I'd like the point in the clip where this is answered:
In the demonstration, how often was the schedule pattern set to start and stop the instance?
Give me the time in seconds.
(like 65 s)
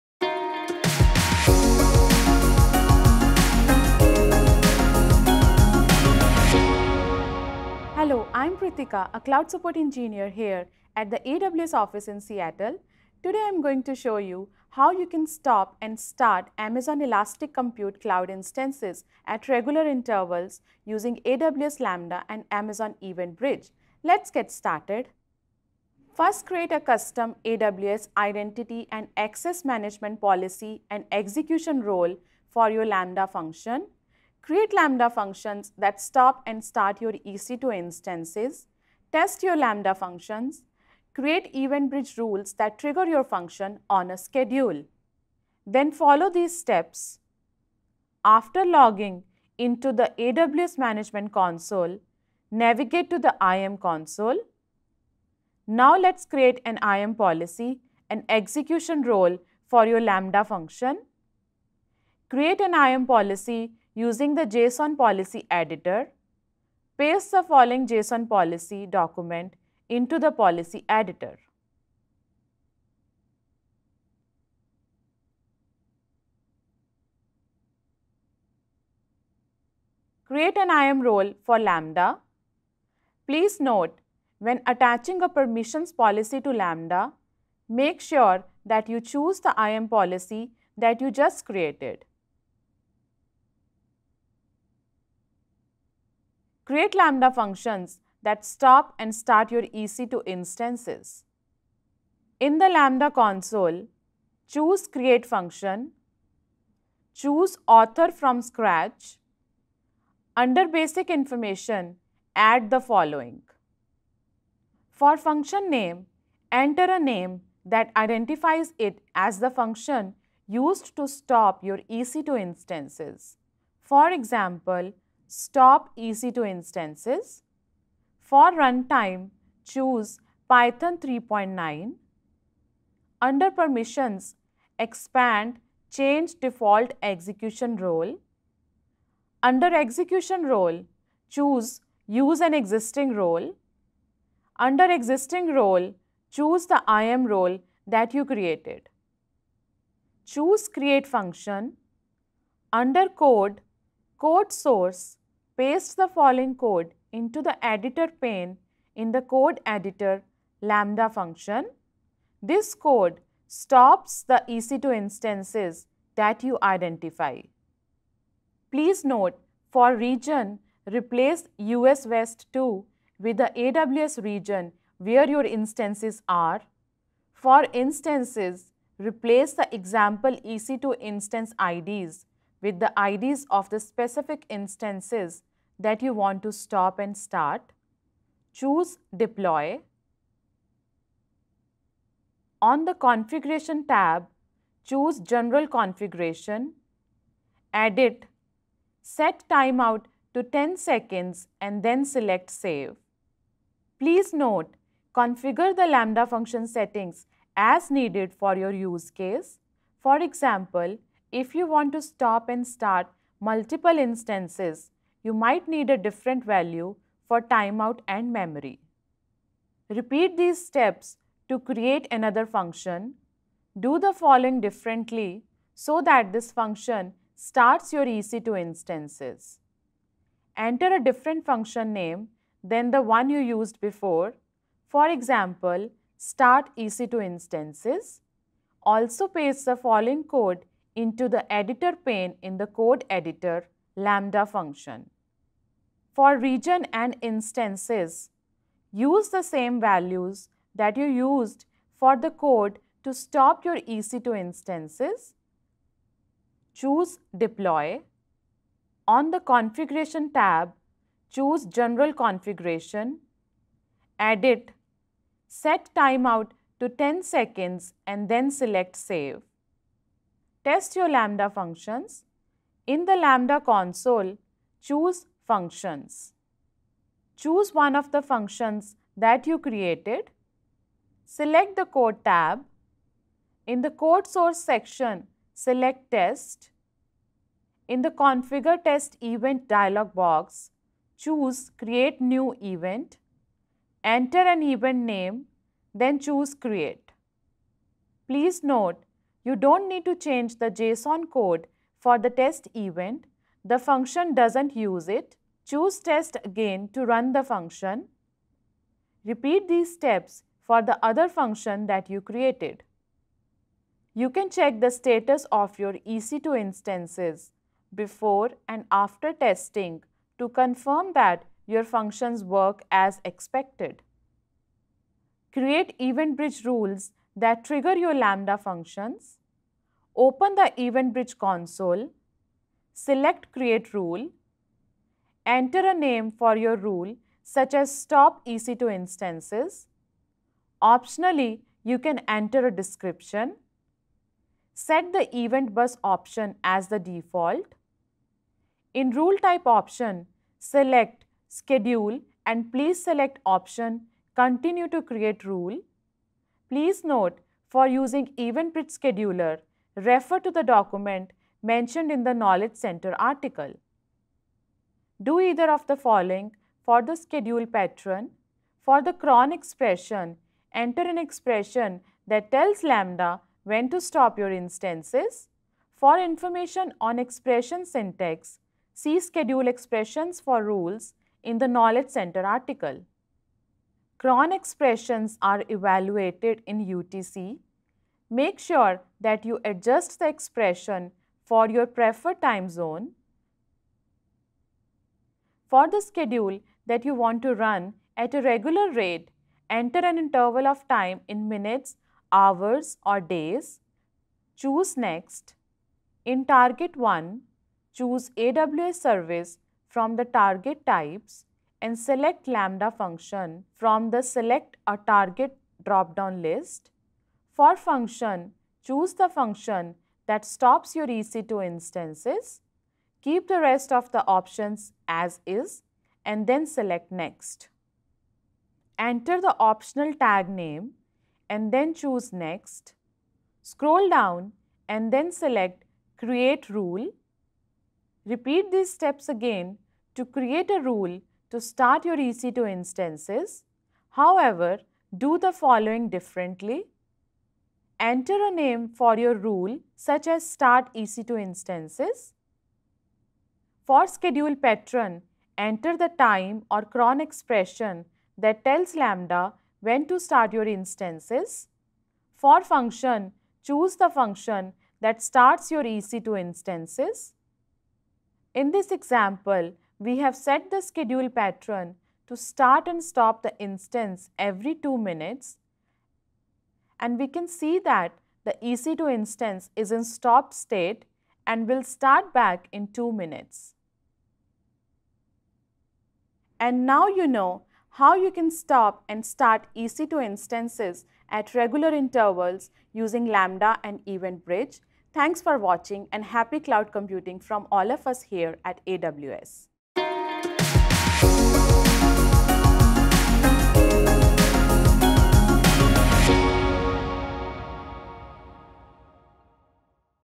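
474 s.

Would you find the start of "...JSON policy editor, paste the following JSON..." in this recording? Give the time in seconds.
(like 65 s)
64 s.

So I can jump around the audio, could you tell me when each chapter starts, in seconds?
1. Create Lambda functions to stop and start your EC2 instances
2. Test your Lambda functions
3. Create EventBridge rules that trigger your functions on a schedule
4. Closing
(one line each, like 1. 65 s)
1. 45 s
2. 165 s
3. 325 s
4. 485 s.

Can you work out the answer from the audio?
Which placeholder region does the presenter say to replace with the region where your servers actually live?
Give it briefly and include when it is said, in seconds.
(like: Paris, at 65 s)
US West 2, at 171 s.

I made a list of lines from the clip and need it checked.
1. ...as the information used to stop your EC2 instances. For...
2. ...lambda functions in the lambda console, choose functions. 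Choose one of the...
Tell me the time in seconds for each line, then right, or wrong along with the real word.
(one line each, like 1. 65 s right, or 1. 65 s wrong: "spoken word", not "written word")
1. 119 s wrong: "function", not "information"
2. 271 s right.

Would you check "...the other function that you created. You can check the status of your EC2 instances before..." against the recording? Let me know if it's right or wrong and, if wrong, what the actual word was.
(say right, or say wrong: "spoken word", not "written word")
right.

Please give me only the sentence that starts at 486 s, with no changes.
And now you know how you can stop and start EC2 instances at regular intervals using Lambda and EventBridge.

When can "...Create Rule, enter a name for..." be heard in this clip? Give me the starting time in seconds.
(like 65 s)
333 s.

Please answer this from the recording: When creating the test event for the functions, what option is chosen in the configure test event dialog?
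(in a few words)
create new event.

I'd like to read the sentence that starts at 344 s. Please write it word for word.
Set the Event Bus option as the default.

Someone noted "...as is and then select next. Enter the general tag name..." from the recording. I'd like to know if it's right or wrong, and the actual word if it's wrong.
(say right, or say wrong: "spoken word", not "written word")
wrong: "optional", not "general".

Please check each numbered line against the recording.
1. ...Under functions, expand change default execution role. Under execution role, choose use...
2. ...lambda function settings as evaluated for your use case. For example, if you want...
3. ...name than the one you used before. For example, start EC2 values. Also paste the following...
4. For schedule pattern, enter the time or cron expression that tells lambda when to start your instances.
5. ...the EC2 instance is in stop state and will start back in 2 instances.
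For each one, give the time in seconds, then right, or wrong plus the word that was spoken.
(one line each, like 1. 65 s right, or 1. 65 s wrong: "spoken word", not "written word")
1. 133 s wrong: "permissions", not "functions"
2. 205 s wrong: "needed", not "evaluated"
3. 231 s wrong: "instances", not "values"
4. 453 s right
5. 478 s wrong: "minutes", not "instances".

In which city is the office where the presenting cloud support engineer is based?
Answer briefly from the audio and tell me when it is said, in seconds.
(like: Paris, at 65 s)
Seattle, at 12 s.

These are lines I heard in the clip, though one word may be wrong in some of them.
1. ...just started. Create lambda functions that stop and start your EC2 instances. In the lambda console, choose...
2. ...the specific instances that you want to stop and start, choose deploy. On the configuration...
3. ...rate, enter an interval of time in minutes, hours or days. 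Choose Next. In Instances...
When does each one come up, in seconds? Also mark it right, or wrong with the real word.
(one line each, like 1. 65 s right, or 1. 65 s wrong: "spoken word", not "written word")
1. 91 s wrong: "created", not "started"
2. 183 s right
3. 398 s wrong: "Target", not "Instances".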